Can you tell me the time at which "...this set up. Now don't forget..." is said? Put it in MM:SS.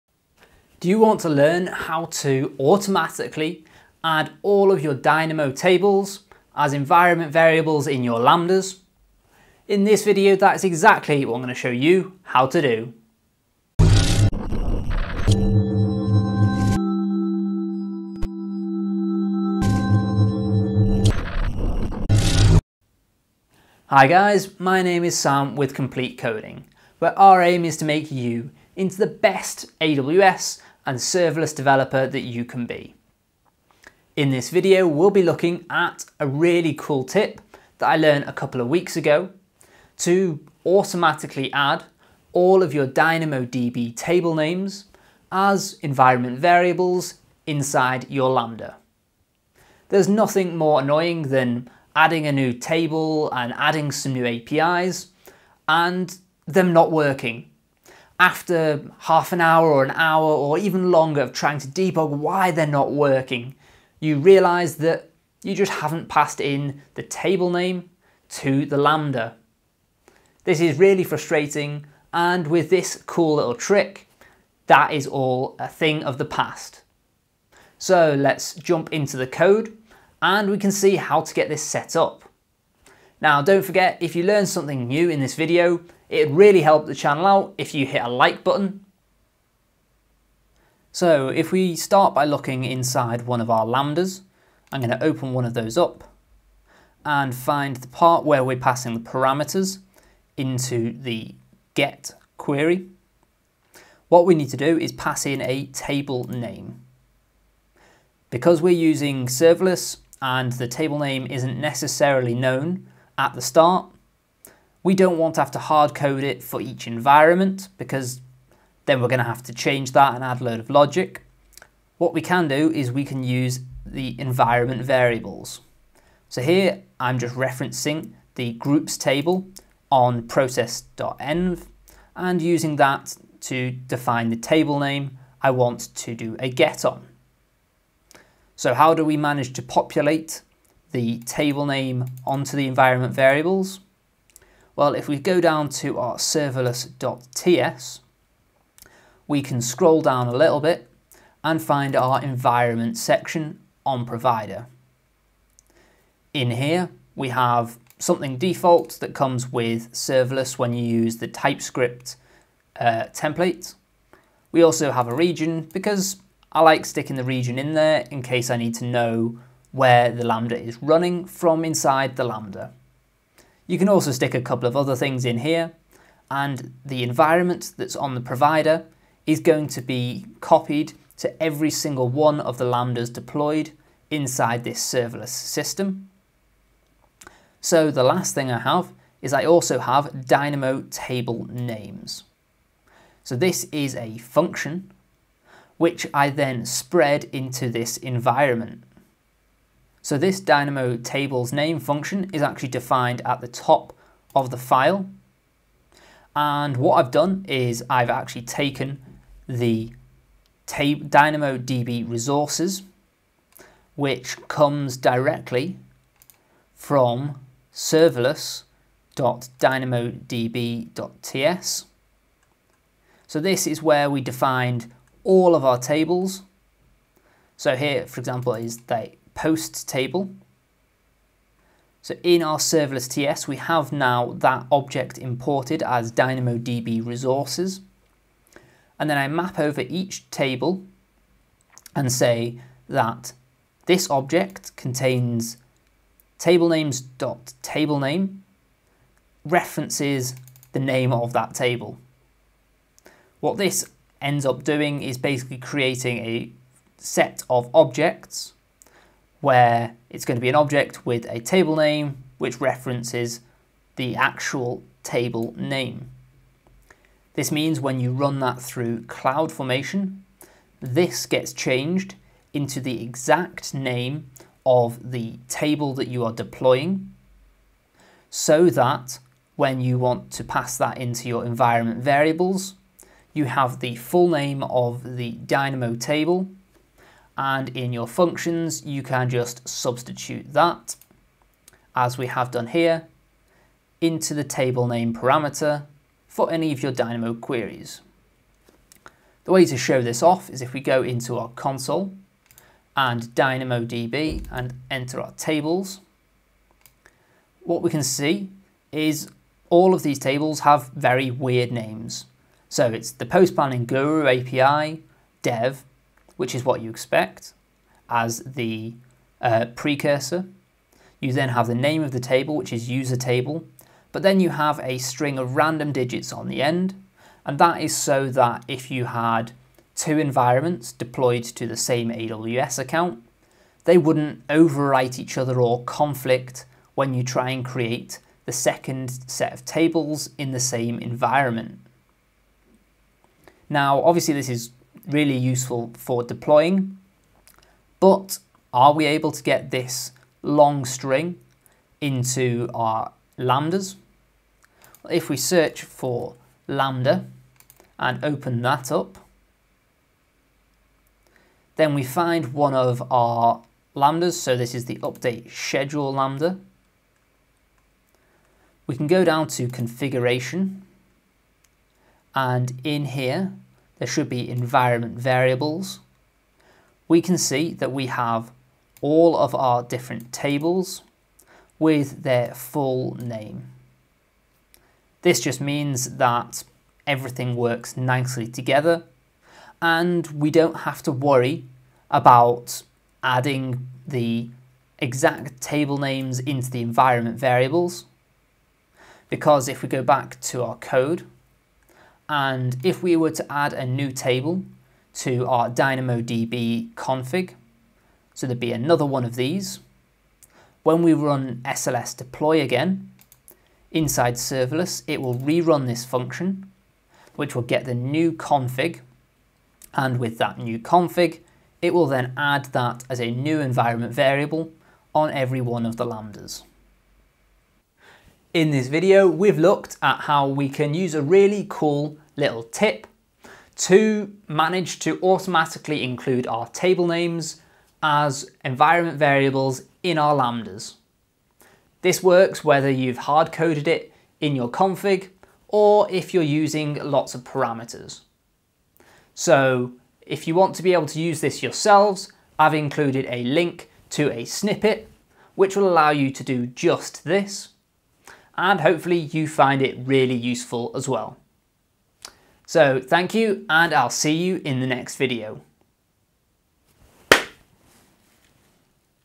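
01:21.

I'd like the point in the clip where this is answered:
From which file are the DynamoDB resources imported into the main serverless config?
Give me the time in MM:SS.
03:37.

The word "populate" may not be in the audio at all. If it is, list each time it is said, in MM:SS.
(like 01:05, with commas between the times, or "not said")
02:19.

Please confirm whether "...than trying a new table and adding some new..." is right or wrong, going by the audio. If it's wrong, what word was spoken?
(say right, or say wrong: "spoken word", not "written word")
wrong: "adding", not "trying".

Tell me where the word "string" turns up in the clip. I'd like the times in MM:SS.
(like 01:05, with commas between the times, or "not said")
05:24, 05:50.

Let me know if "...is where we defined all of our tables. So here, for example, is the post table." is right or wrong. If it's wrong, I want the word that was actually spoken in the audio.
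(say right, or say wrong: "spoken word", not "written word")
right.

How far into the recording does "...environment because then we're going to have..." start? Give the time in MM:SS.
01:56.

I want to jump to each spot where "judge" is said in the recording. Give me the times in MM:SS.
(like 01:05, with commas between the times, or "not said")
not said.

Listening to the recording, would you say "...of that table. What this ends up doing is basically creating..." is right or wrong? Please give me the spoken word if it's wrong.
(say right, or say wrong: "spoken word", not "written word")
right.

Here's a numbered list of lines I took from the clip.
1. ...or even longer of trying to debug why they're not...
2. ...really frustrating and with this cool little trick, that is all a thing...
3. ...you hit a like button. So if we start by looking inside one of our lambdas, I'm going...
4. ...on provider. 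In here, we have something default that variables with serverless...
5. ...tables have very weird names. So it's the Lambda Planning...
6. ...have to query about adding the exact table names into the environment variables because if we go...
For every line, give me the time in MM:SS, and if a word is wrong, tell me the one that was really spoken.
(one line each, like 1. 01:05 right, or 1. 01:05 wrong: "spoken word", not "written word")
1. 01:00 right
2. 01:10 right
3. 01:27 right
4. 02:33 wrong: "comes", not "variables"
5. 05:10 wrong: "Post", not "Lambda"
6. 06:30 wrong: "worry", not "query".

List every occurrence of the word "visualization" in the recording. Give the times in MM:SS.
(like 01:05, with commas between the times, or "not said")
not said.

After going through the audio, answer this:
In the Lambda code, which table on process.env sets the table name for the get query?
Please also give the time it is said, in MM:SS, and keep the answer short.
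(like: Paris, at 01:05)
groups table, at 02:08.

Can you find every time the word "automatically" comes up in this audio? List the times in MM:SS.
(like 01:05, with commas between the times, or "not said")
00:02, 00:40, 07:15.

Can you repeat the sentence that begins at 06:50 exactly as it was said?
When we run SLS deploy again, inside serverless, it will rerun this function, which will get the new config.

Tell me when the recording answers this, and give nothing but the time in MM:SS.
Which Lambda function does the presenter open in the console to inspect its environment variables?
06:04.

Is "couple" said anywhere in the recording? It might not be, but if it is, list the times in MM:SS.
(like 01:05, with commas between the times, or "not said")
00:38, 02:54.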